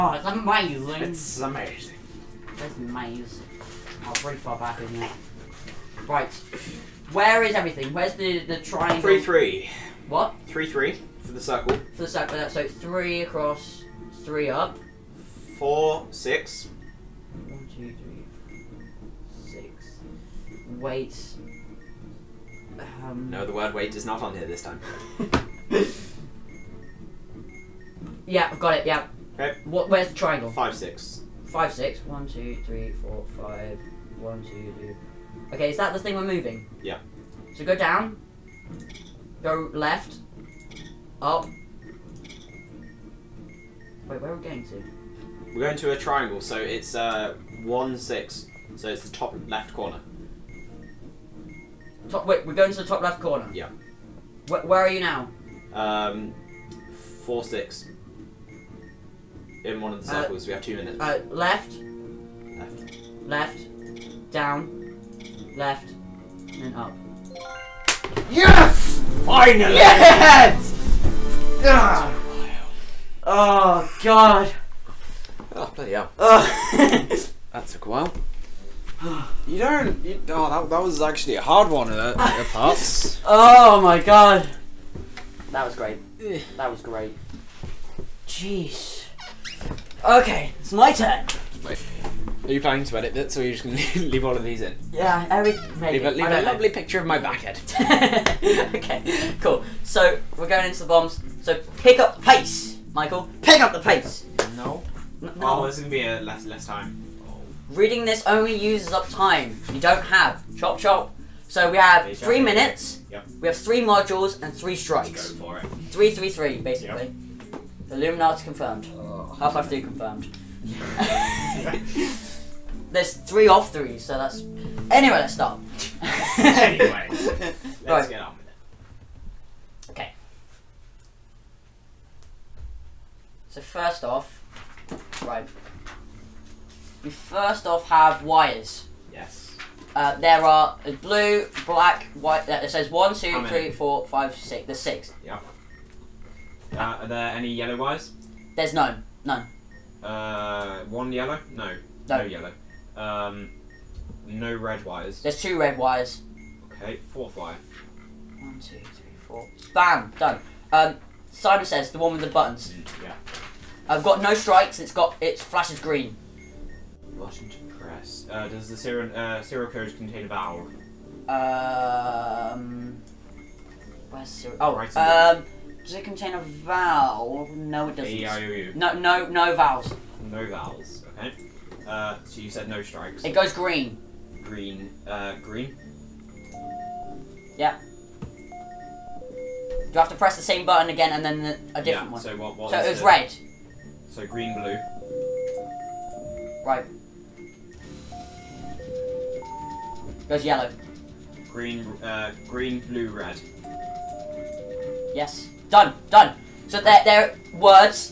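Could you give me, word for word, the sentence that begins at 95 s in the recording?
Leave a, leave a lovely picture of my back head.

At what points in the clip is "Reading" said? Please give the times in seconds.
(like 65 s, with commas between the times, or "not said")
107 s.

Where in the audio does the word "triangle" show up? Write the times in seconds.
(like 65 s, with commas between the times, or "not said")
8 s, 30 s, 45 s.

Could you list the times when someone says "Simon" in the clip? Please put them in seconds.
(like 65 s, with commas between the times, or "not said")
161 s.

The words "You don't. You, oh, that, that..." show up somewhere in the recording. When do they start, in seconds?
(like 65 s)
79 s.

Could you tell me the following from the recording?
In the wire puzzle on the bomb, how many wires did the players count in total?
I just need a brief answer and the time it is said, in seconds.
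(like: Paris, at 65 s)
6, at 144 s.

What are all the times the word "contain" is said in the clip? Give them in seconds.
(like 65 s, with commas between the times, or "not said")
169 s, 176 s.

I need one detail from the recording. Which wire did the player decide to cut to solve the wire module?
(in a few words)
Fourth wire.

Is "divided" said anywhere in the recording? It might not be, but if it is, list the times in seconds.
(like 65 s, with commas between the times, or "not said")
not said.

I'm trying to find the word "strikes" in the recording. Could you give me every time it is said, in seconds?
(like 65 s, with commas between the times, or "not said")
114 s, 164 s, 182 s.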